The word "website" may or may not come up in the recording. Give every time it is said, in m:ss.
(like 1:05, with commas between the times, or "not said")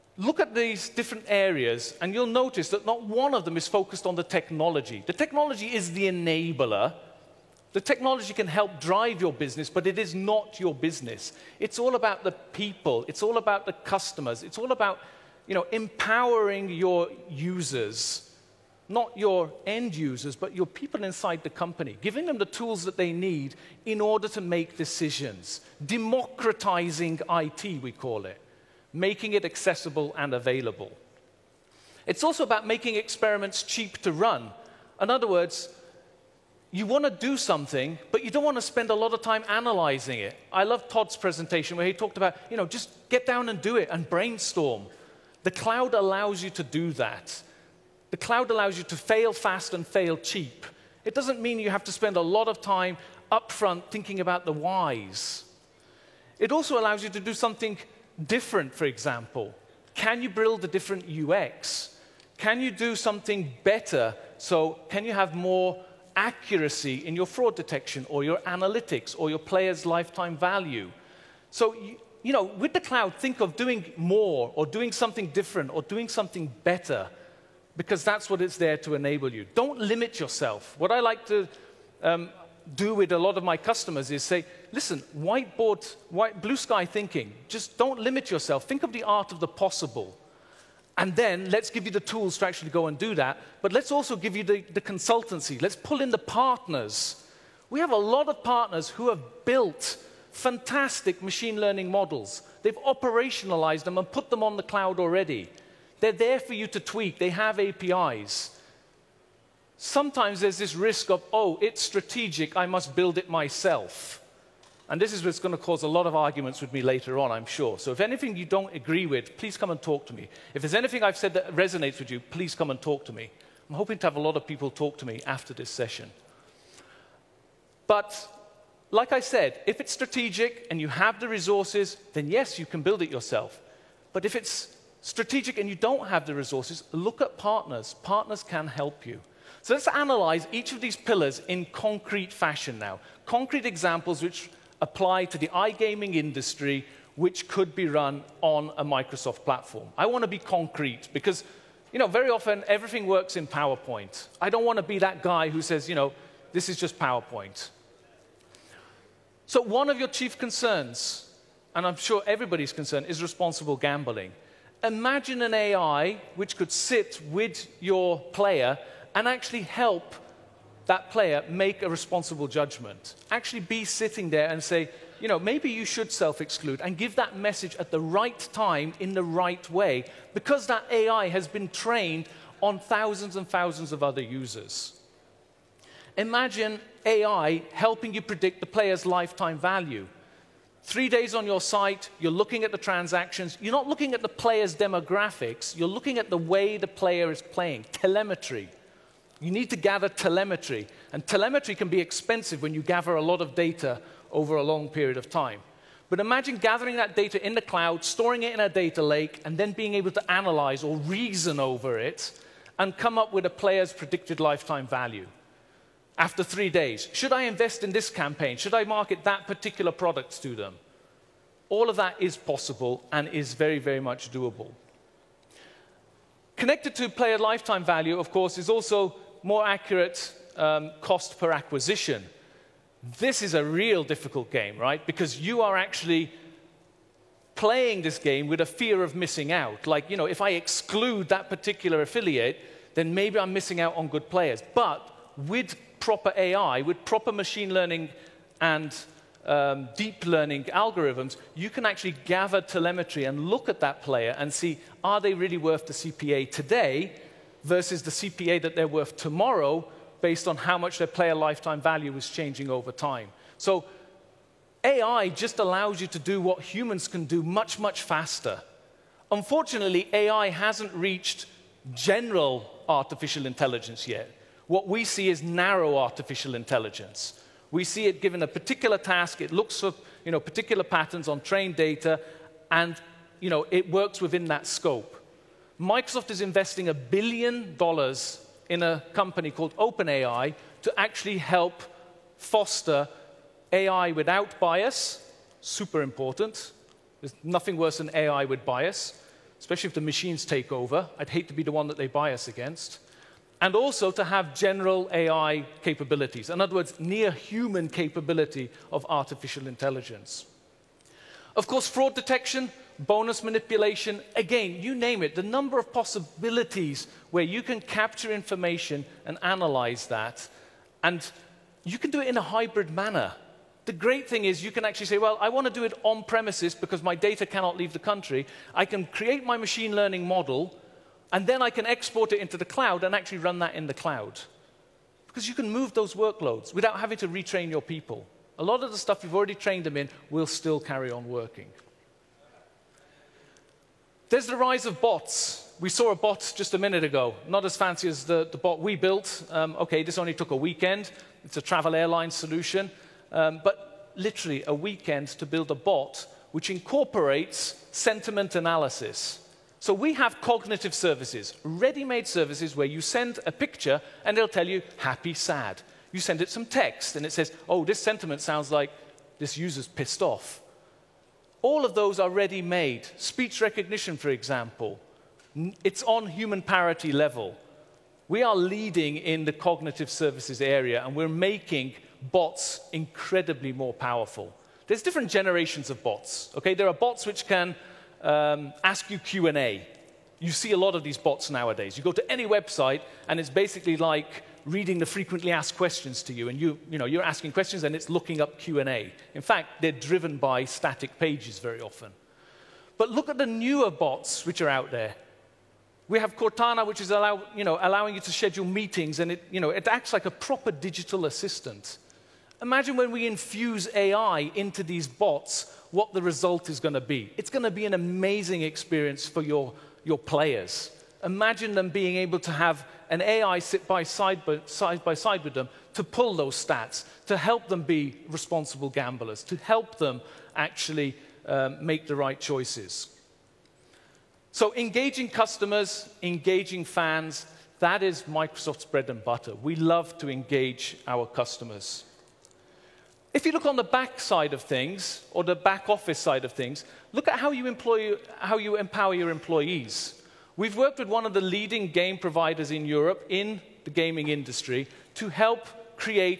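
6:32.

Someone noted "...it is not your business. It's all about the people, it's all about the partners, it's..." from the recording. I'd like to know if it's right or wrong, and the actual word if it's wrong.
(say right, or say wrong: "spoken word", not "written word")
wrong: "customers", not "partners".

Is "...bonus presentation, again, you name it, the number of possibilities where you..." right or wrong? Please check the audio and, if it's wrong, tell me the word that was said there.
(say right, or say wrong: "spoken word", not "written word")
wrong: "manipulation", not "presentation".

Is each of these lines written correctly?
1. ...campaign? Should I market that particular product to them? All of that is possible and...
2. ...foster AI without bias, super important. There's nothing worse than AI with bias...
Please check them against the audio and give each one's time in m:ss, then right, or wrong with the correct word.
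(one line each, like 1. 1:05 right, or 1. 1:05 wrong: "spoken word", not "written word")
1. 3:38 right
2. 4:52 right.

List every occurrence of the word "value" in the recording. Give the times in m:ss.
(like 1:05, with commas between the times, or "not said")
1:10, 3:09, 3:34, 3:47, 4:21.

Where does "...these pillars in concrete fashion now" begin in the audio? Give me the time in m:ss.
2:20.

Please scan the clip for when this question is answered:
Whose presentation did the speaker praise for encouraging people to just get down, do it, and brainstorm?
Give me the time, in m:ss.
0:40.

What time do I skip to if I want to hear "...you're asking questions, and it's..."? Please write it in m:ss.
6:37.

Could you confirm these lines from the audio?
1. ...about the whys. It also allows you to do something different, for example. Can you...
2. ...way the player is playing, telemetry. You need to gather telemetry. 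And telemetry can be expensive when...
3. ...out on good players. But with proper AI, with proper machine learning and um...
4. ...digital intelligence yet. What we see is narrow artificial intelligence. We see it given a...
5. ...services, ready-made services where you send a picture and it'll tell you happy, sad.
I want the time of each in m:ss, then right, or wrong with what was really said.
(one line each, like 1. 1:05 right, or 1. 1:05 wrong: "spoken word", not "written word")
1. 0:54 right
2. 3:16 right
3. 4:03 right
4. 4:32 wrong: "artificial", not "digital"
5. 6:00 right.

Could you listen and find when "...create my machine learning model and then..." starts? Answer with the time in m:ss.
5:29.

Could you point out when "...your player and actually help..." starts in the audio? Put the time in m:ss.
2:47.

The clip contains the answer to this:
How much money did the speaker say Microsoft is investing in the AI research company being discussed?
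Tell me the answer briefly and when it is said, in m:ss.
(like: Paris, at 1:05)
a billion dollars, at 4:46.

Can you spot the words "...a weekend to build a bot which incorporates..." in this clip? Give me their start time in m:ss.
5:54.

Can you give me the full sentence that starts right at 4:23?
So AI just allows you to do what humans can do much, much faster.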